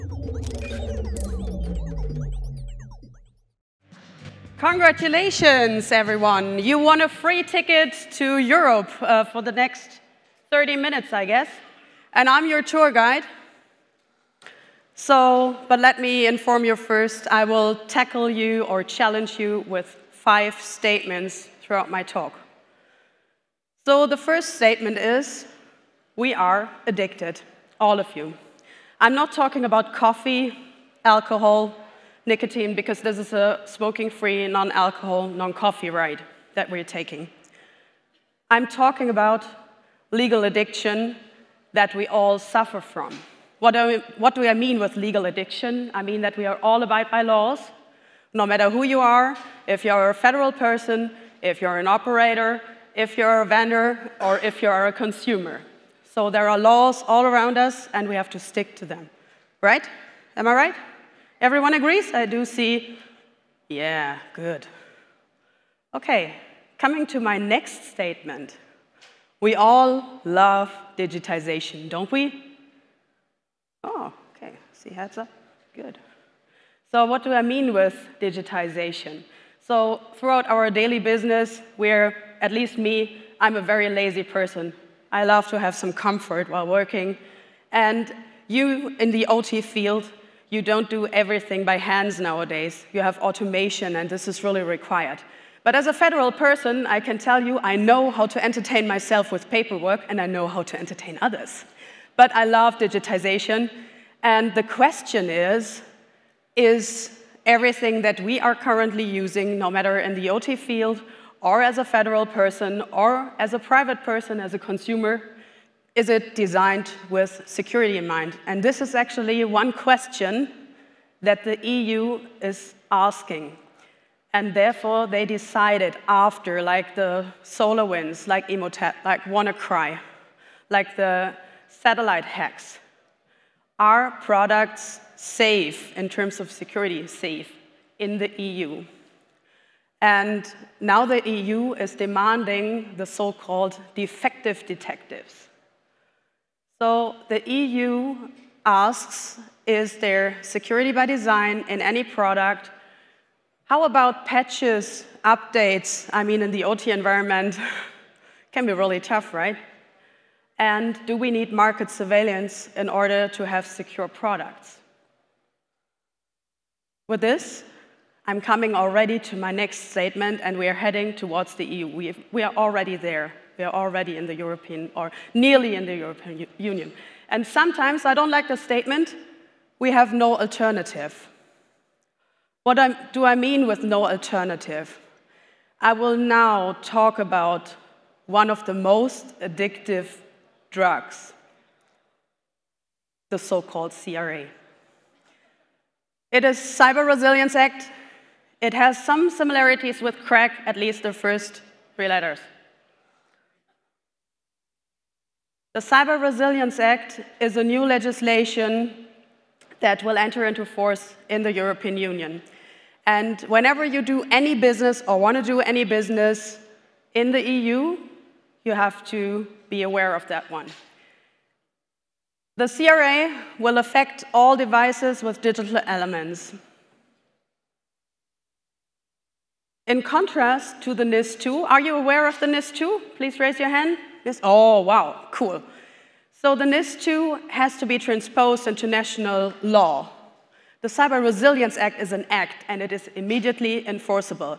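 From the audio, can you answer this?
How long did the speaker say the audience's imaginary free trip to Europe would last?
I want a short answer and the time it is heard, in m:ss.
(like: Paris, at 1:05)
30 minutes, at 0:10.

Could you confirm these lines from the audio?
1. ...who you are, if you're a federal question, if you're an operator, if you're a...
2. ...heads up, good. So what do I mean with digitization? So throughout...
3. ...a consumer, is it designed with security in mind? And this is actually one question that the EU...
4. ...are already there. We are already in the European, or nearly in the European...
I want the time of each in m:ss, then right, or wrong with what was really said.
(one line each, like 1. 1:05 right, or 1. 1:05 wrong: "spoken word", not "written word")
1. 0:48 wrong: "person", not "question"
2. 1:14 right
3. 1:54 right
4. 2:52 right.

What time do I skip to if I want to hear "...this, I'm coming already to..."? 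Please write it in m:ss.
2:47.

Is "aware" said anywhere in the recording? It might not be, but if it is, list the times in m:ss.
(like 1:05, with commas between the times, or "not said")
3:39, 3:51.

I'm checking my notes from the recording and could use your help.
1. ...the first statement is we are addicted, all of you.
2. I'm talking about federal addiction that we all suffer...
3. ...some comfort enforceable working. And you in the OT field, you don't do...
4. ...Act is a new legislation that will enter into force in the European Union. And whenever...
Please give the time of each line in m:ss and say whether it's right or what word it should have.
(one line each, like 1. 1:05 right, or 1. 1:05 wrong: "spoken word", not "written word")
1. 0:24 right
2. 0:38 wrong: "legal", not "federal"
3. 1:25 wrong: "while", not "enforceable"
4. 3:26 right.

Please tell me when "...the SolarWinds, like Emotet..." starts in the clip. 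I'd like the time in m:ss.
2:06.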